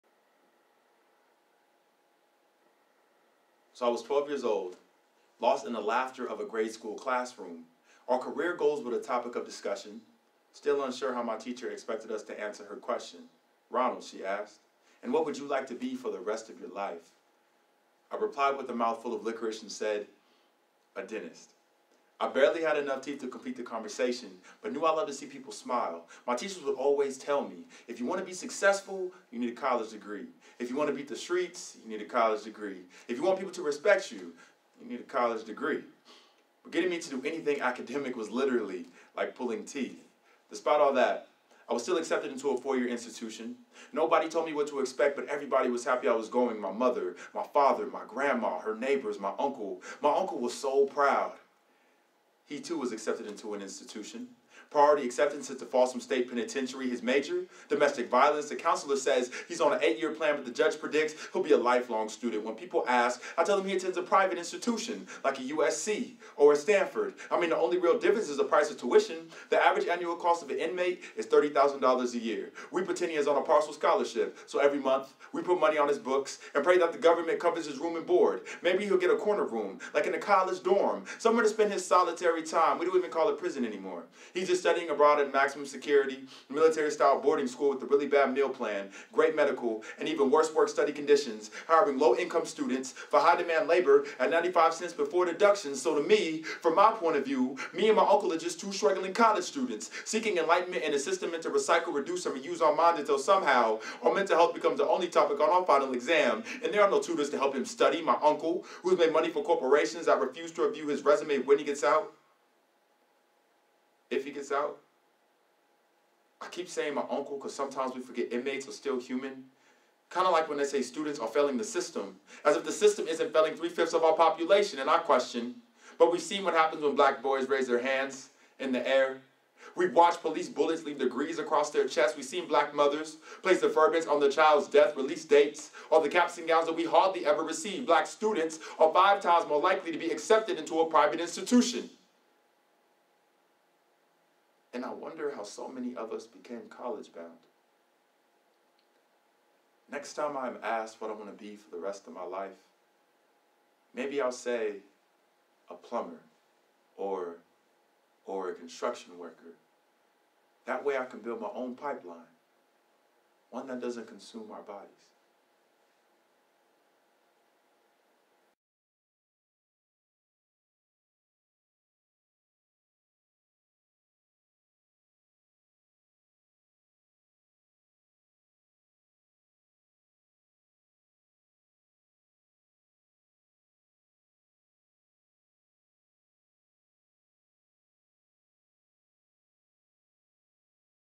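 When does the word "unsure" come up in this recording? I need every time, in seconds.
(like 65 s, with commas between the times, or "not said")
10 s.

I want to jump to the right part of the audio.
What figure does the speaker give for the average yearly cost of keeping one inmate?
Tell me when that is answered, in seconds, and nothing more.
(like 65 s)
71 s.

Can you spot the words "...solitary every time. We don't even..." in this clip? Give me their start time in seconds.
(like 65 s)
81 s.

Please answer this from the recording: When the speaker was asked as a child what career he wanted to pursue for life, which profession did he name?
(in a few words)
dentist.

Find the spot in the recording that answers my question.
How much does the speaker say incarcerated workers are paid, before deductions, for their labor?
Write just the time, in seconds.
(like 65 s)
94 s.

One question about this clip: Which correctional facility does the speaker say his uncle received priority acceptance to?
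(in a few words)
Folsom State Penitentiary.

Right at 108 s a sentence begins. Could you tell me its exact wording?
My uncle, who's made money for corporations that refuse to review his resume when he gets out, if he gets out.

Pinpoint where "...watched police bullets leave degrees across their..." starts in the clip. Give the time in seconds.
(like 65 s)
129 s.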